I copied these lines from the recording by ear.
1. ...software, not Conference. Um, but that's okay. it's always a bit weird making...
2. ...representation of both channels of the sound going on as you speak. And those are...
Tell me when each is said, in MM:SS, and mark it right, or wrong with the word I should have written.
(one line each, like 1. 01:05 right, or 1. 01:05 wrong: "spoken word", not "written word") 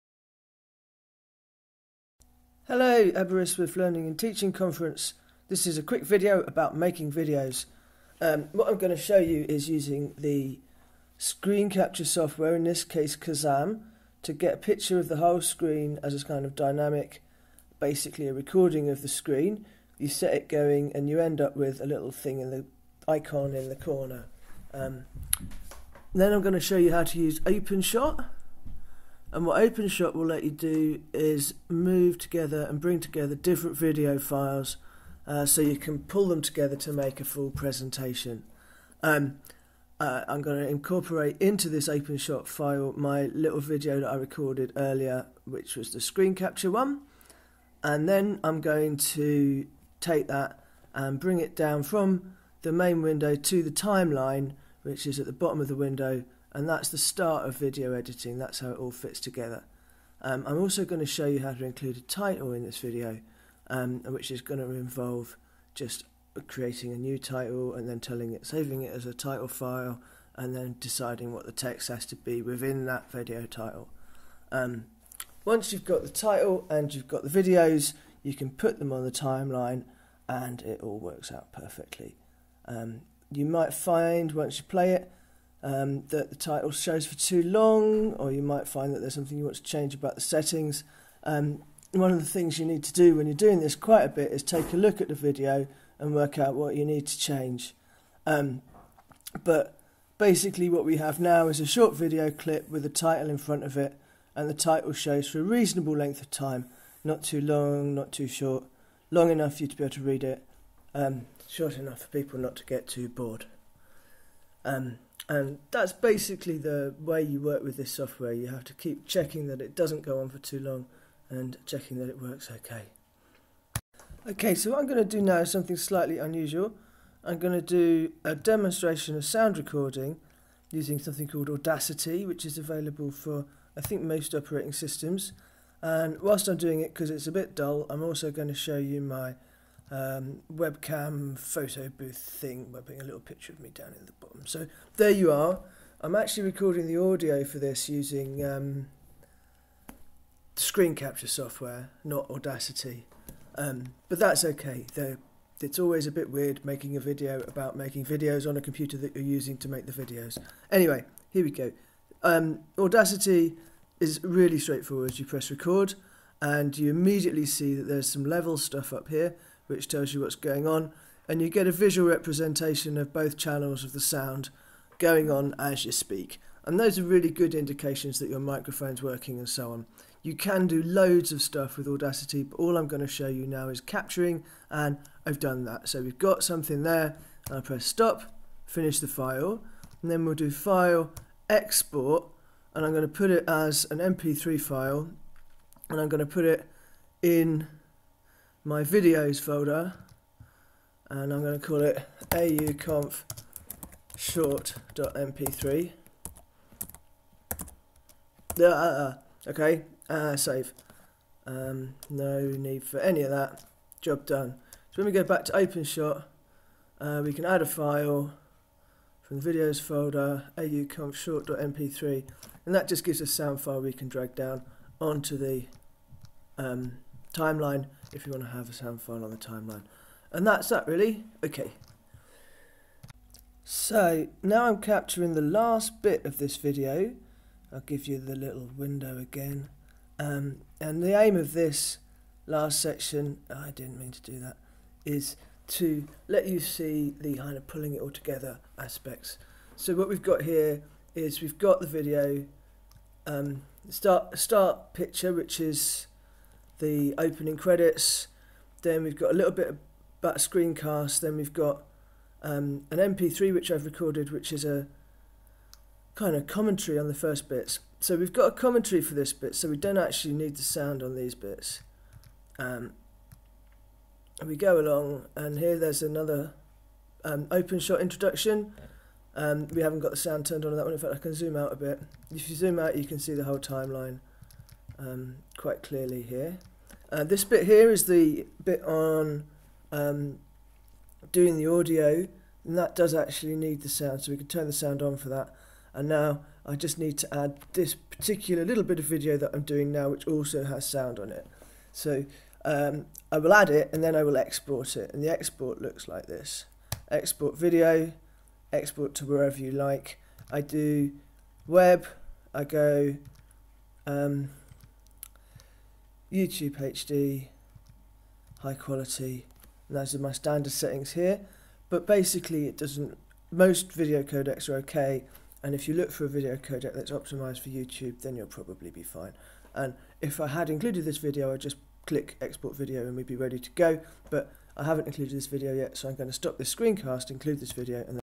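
1. 02:31 wrong: "Audacity", not "Conference"
2. 02:52 right.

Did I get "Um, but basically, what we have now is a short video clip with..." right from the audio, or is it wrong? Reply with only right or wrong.
right.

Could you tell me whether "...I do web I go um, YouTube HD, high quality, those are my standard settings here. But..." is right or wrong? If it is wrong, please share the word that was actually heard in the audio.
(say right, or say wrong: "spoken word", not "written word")
right.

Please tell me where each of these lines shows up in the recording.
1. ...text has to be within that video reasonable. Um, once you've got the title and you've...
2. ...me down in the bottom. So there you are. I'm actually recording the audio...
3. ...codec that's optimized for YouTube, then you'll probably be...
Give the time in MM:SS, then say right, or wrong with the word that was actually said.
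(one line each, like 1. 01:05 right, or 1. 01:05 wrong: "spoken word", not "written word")
1. 01:11 wrong: "title", not "reasonable"
2. 02:23 right
3. 05:26 right.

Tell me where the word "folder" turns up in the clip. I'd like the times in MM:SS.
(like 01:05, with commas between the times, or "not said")
03:19, 03:39.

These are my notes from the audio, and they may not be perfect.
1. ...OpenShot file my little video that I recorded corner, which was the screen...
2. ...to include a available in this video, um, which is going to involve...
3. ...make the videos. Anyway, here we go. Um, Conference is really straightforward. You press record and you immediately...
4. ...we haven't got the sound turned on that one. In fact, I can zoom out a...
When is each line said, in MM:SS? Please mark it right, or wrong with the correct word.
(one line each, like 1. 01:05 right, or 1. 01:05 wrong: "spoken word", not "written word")
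1. 00:41 wrong: "earlier", not "corner"
2. 01:01 wrong: "title", not "available"
3. 02:39 wrong: "Audacity", not "Conference"
4. 04:39 right.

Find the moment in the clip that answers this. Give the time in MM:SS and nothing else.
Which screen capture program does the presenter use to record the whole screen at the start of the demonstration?
00:13.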